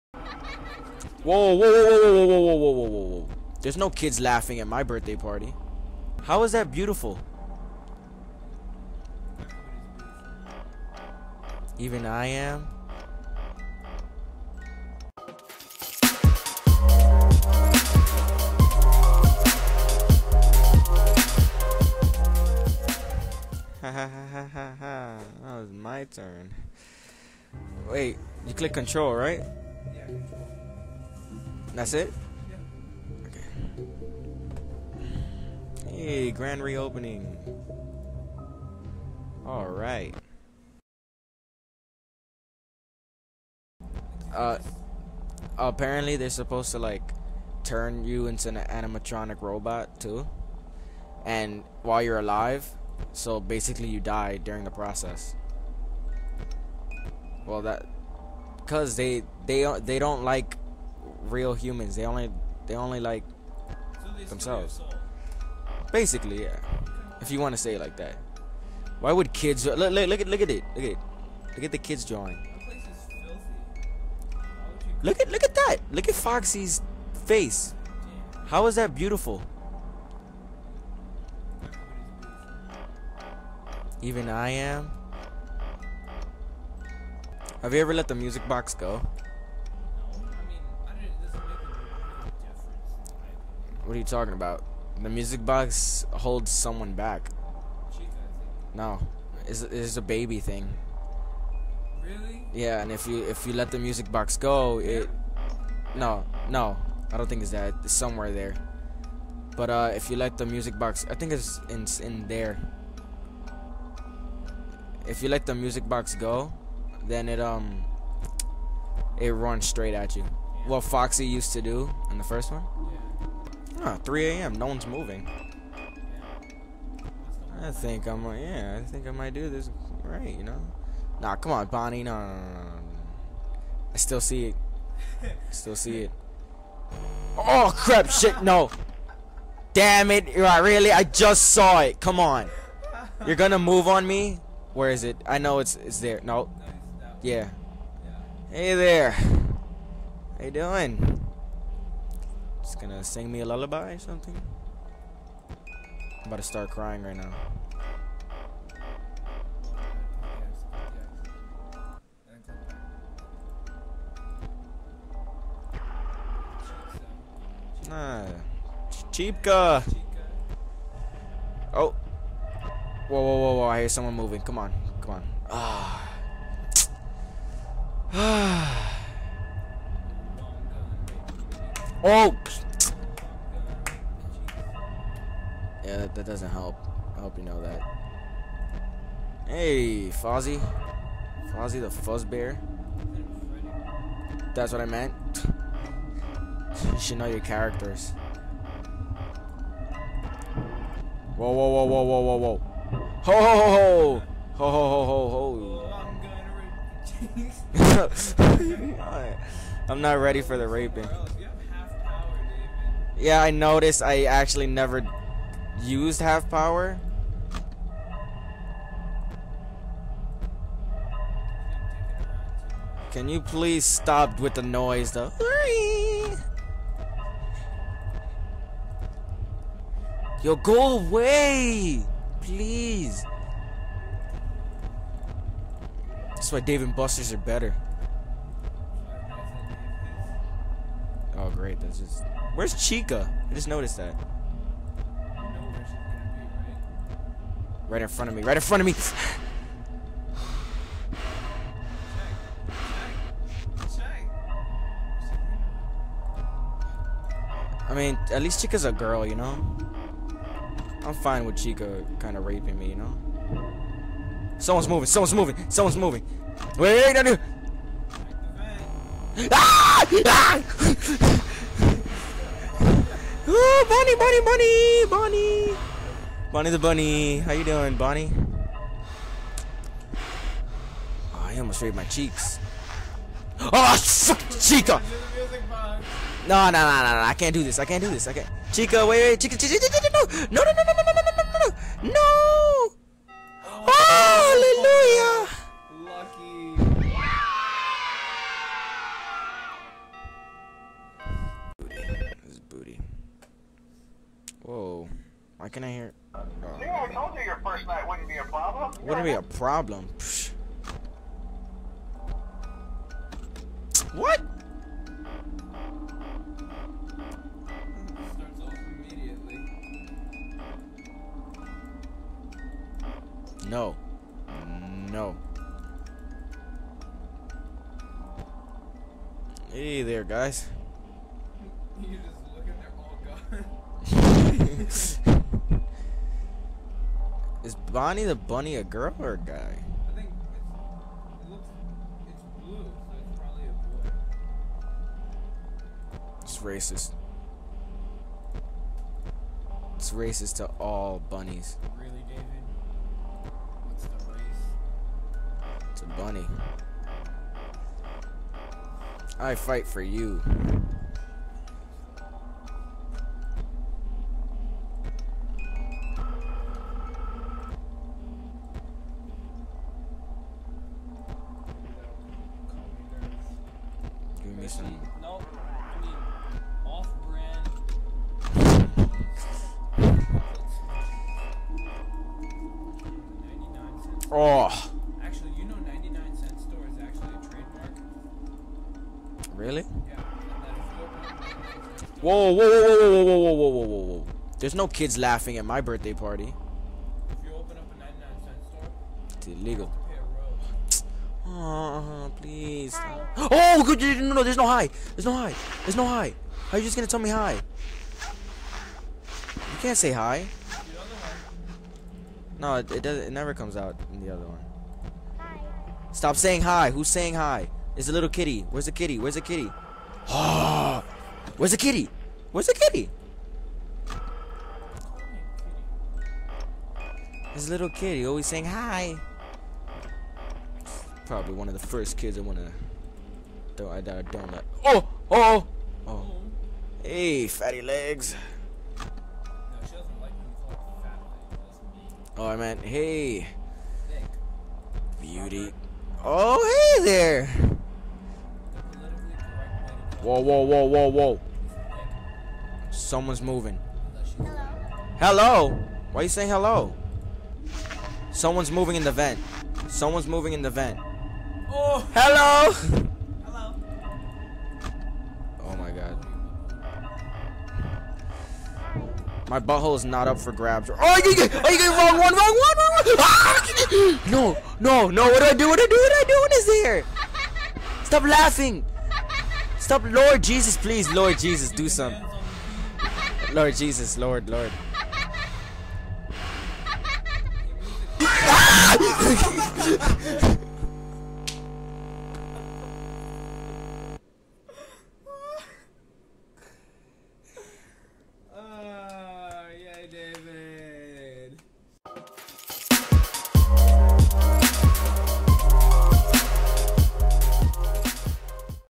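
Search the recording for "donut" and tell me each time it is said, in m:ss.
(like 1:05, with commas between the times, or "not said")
7:14.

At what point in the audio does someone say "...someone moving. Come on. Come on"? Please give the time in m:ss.
2:53.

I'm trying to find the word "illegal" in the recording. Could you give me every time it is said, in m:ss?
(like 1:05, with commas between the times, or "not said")
6:39.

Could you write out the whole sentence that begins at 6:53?
It never comes out in the other one.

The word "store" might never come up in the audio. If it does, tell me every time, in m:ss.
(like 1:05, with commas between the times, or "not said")
6:26, 6:38.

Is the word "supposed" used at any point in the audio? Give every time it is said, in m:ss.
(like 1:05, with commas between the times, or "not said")
0:46.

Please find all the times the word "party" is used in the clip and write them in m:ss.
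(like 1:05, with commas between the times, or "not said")
0:05, 6:36.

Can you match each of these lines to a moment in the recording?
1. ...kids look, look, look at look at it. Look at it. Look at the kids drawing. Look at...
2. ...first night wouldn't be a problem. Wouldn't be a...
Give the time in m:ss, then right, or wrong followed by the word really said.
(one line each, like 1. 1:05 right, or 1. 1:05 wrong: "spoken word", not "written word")
1. 1:09 right
2. 5:07 right.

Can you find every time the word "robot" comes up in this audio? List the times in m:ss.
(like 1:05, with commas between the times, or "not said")
0:49.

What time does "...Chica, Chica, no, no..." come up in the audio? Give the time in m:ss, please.
4:49.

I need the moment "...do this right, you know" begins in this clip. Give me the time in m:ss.
2:09.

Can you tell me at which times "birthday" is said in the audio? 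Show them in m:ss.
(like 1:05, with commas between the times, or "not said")
0:04, 6:35.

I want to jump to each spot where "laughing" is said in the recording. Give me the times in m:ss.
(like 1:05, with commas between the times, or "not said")
0:04, 6:35, 7:58.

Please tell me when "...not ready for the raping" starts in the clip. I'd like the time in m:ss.
3:30.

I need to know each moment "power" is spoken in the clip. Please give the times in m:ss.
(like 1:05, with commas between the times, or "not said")
3:36.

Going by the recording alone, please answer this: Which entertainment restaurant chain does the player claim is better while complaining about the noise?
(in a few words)
Dave and Buster's.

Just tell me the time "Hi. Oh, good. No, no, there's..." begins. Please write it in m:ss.
6:42.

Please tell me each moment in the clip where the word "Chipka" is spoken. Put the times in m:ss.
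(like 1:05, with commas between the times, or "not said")
2:49.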